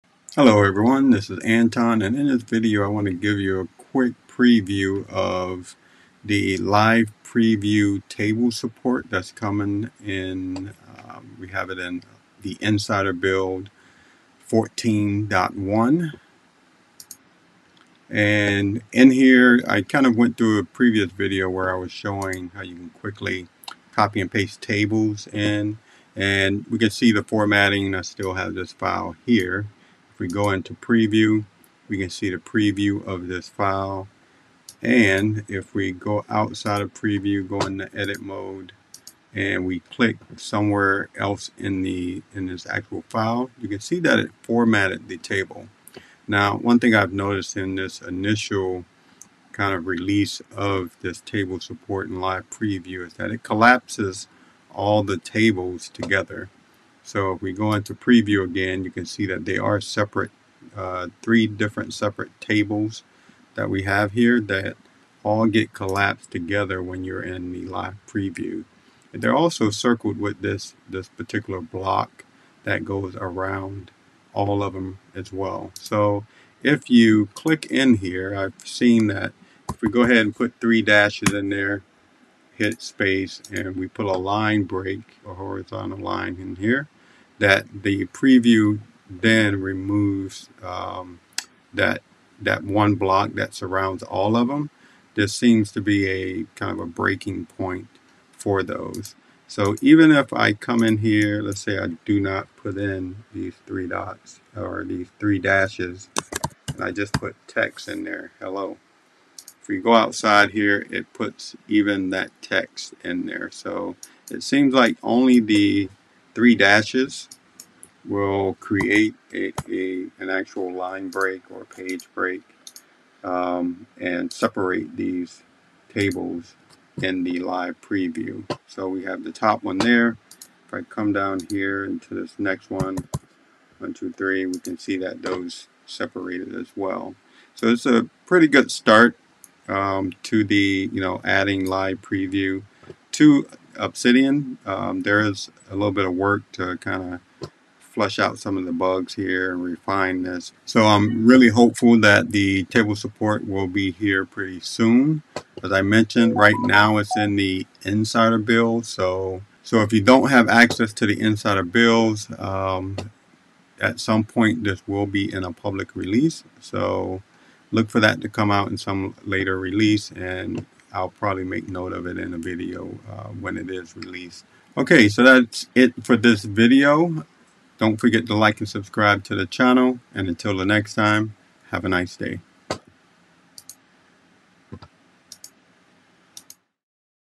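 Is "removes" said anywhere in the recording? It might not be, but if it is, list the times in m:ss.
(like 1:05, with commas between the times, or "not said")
1:29.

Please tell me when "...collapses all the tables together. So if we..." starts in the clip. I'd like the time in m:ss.
0:53.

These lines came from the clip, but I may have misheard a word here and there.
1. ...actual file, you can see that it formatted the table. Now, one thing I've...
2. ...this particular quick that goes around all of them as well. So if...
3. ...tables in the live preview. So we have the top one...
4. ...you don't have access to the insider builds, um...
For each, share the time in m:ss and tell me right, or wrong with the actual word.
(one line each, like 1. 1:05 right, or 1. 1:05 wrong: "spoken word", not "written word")
1. 0:42 right
2. 1:10 wrong: "block", not "quick"
3. 2:05 right
4. 2:39 right.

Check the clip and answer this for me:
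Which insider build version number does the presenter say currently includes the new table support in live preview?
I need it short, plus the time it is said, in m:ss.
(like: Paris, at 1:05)
14.1, at 0:14.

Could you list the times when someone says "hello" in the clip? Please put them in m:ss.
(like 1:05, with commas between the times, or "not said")
0:00, 1:48.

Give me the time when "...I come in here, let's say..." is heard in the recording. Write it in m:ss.
1:40.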